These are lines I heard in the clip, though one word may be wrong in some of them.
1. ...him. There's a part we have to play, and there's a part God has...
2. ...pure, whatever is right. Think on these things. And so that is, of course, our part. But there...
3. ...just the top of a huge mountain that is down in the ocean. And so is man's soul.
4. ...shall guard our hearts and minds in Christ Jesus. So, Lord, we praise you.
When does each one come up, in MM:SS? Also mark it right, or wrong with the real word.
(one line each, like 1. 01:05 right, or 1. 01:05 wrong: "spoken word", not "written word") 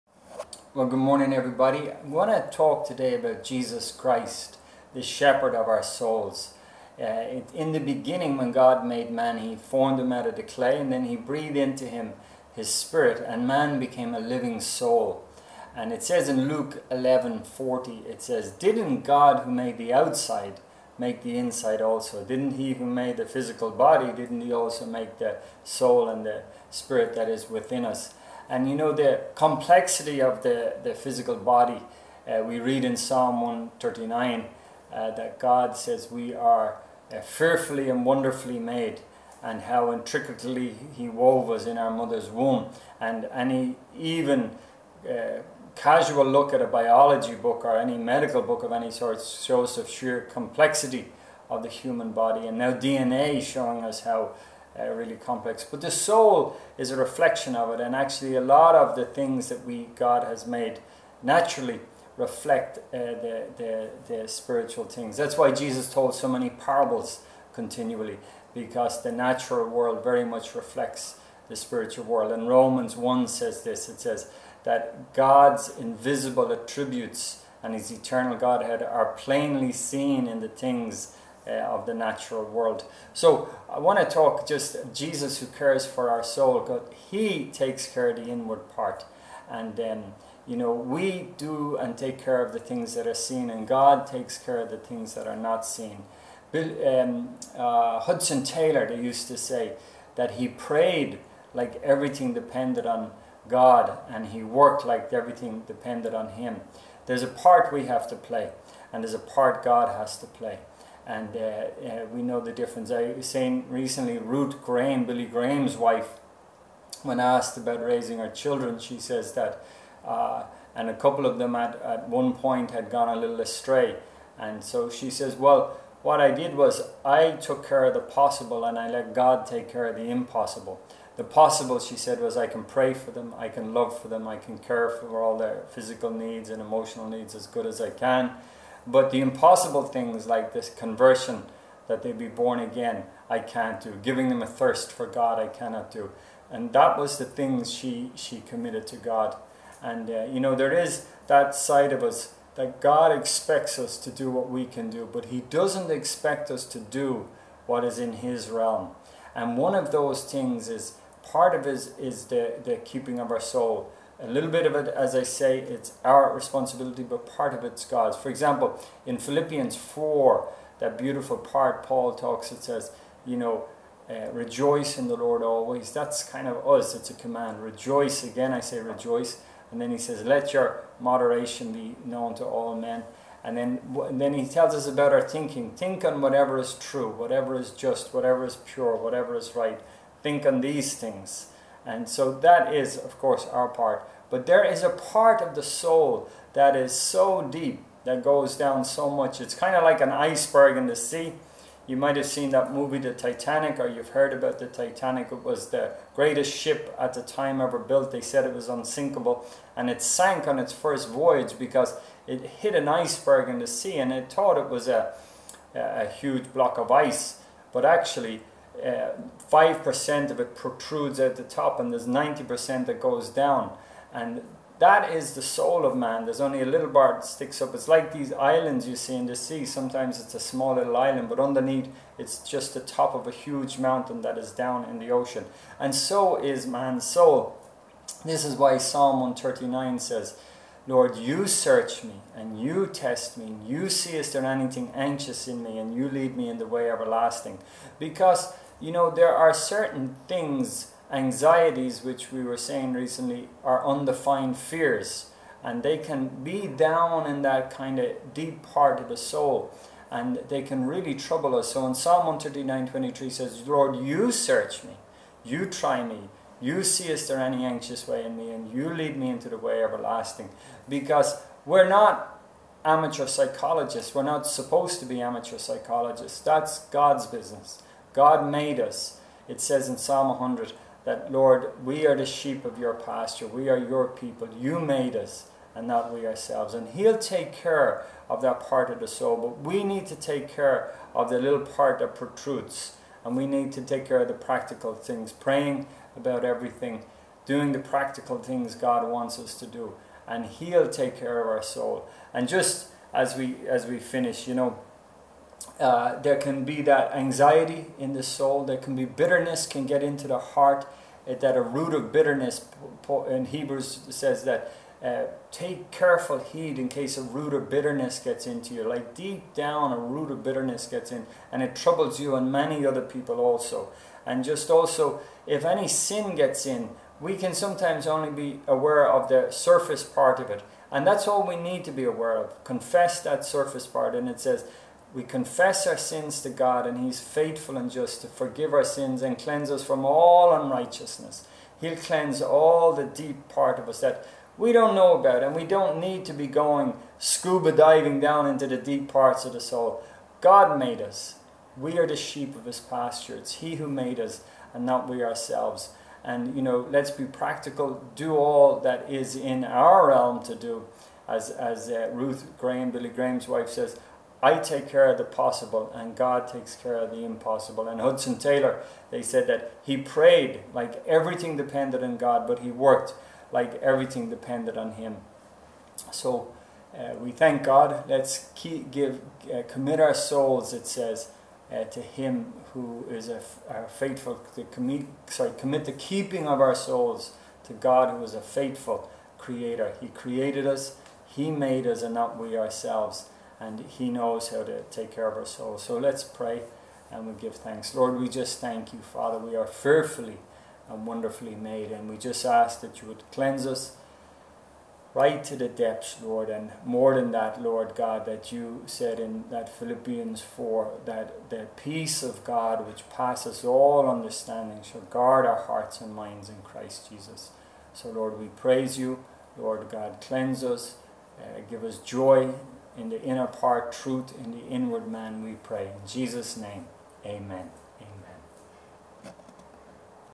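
1. 01:46 right
2. 03:08 right
3. 03:52 right
4. 06:54 right.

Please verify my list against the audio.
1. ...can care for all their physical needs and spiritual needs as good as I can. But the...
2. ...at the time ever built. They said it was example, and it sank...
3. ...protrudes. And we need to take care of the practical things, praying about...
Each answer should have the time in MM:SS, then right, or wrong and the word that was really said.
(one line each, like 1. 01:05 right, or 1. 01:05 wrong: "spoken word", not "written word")
1. 02:14 wrong: "emotional", not "spiritual"
2. 03:26 wrong: "unsinkable", not "example"
3. 04:52 right.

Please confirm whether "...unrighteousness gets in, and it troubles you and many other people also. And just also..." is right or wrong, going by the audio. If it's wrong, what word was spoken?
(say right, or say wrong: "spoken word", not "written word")
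wrong: "bitterness", not "unrighteousness".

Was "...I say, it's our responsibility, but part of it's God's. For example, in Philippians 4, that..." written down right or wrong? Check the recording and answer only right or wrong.
right.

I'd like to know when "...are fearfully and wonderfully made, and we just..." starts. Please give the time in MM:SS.
06:39.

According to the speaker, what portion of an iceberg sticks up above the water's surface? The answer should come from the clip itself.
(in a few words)
5%.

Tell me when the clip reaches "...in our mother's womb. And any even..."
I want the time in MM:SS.
00:41.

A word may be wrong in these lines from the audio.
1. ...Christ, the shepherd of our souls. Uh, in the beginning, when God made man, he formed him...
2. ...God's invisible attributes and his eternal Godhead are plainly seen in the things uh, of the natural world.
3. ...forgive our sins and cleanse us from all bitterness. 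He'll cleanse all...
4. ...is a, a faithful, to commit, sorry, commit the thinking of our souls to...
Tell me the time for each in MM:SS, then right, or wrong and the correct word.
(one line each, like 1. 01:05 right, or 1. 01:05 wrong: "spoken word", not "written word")
1. 00:03 right
2. 01:15 right
3. 05:38 wrong: "unrighteousness", not "bitterness"
4. 06:23 wrong: "keeping", not "thinking".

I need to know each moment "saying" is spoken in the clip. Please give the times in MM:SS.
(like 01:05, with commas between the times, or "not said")
01:53, 04:12.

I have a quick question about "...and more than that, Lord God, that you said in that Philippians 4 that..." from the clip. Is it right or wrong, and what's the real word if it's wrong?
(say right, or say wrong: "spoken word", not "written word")
right.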